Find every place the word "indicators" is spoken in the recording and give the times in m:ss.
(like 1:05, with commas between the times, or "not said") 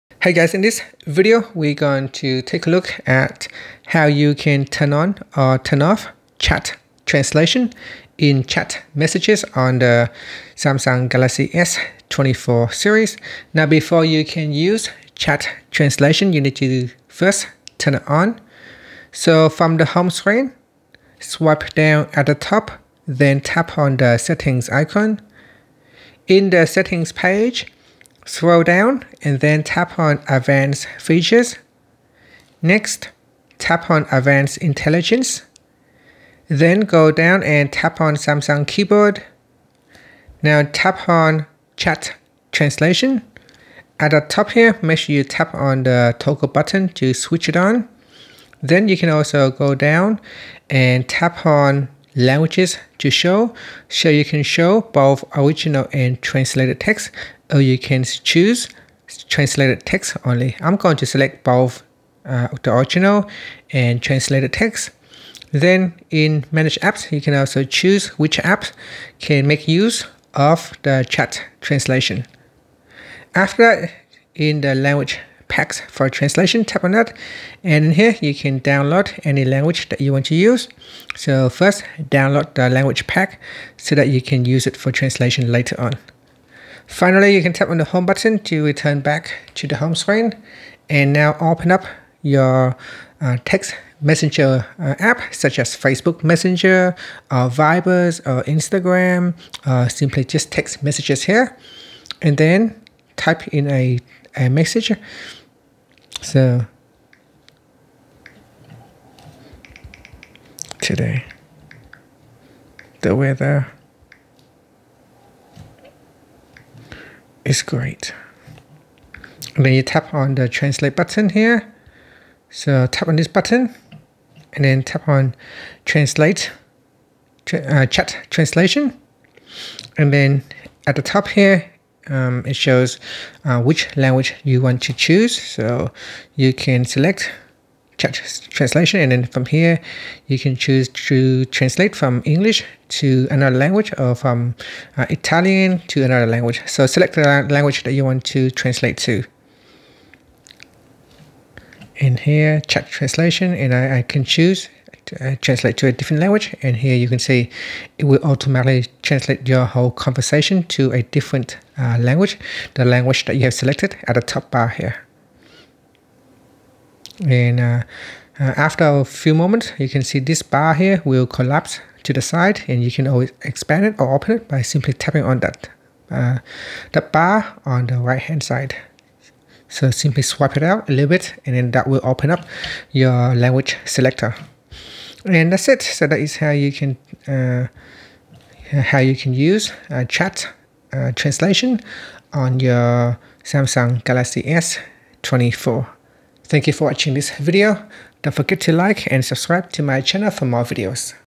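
not said.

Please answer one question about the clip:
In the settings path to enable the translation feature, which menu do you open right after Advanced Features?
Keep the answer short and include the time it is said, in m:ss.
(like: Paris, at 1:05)
Advanced Intelligence, at 0:34.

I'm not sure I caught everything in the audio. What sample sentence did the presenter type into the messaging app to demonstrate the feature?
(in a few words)
Today, the weather is great.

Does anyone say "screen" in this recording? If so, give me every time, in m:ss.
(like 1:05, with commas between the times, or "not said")
0:20, 1:29.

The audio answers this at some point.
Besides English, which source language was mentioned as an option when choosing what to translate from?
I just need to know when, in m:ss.
2:25.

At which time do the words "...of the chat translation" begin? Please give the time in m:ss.
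1:10.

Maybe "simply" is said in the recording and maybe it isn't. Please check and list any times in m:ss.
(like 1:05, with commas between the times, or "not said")
1:39, 2:54, 2:59.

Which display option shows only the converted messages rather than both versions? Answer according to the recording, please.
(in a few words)
Translated text only.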